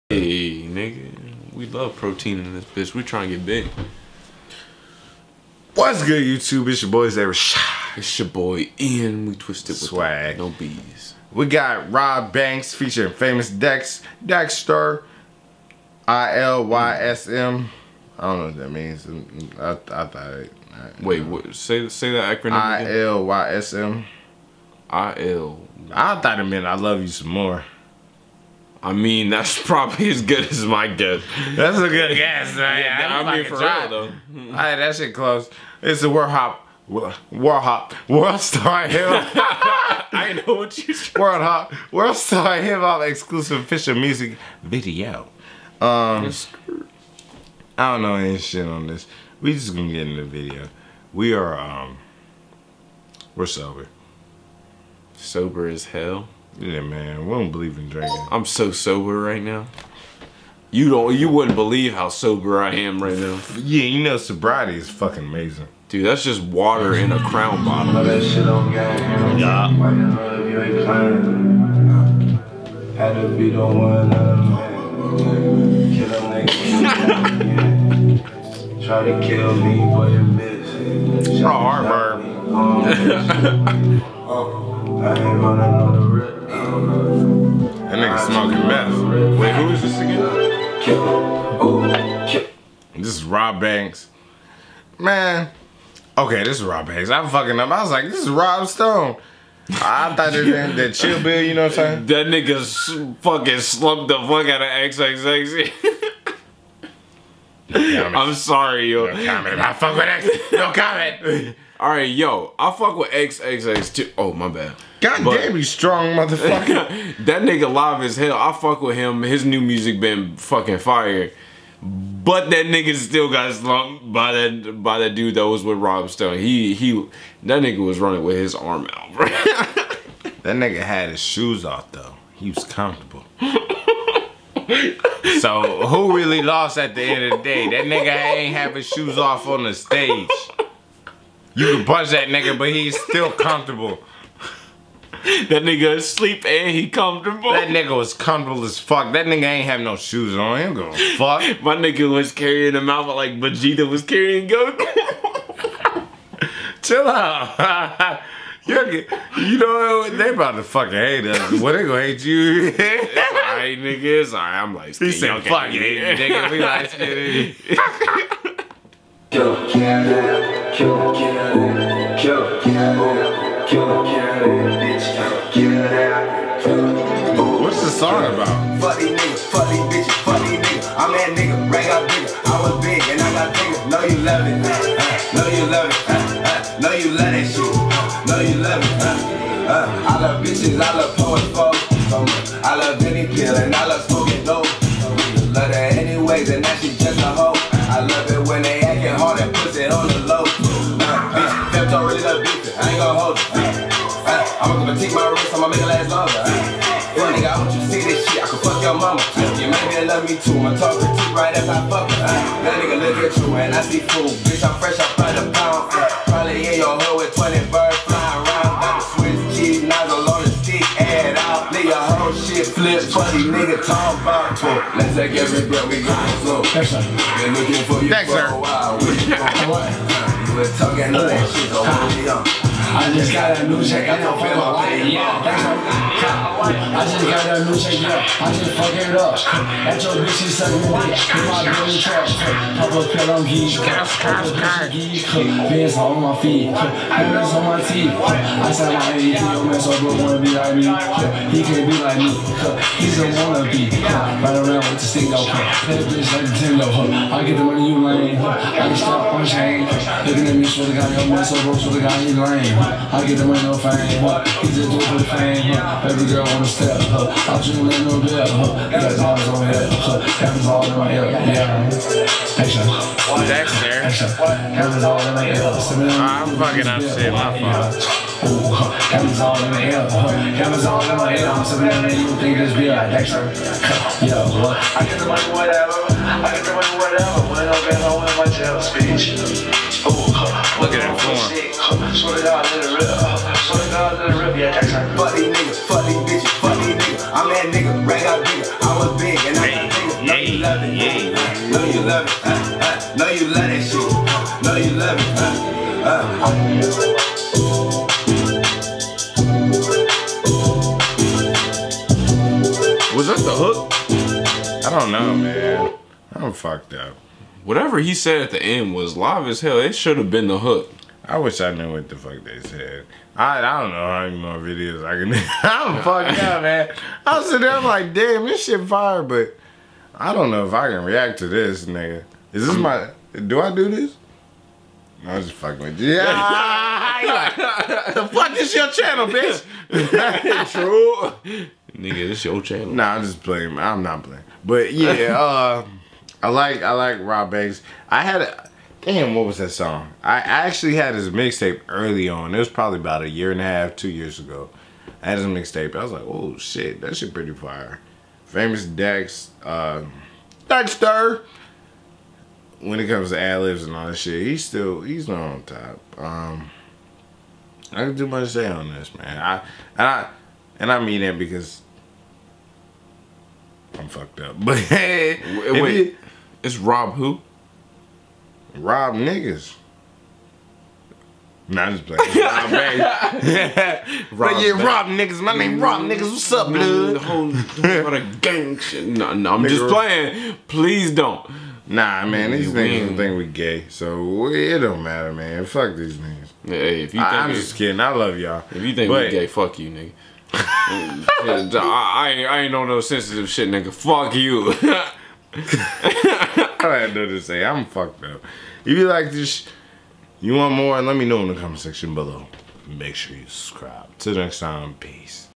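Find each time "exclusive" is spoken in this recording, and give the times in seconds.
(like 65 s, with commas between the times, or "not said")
43 s.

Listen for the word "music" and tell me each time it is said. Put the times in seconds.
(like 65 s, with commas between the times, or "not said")
43 s, 119 s.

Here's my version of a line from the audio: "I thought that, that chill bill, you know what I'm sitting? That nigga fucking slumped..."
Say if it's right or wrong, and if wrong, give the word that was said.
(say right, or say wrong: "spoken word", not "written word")
wrong: "saying", not "sitting".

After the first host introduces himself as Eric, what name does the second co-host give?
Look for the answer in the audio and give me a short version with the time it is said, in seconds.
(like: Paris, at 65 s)
Ian, at 8 s.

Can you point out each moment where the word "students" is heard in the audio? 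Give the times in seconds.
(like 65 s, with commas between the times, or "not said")
not said.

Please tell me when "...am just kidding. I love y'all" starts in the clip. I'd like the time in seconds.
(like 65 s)
397 s.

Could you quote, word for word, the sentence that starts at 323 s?
I I don't know how many more videos I can.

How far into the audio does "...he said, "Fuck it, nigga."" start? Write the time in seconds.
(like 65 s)
164 s.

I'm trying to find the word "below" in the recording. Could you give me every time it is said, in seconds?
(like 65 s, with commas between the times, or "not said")
412 s.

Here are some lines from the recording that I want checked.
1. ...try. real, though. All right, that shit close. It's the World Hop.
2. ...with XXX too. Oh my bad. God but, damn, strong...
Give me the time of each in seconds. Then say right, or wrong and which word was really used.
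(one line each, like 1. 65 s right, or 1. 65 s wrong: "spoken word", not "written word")
1. 33 s right
2. 112 s right.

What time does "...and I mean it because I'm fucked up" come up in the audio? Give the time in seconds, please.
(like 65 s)
370 s.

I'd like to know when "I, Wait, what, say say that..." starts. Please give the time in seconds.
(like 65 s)
20 s.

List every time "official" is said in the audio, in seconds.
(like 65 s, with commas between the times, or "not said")
43 s.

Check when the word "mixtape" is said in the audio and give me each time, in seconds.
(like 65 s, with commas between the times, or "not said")
351 s, 355 s.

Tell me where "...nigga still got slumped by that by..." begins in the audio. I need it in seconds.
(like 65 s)
122 s.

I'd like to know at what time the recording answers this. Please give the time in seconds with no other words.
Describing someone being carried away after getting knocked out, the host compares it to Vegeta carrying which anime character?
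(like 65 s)
154 s.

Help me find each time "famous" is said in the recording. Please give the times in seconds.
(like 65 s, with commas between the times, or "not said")
13 s, 358 s.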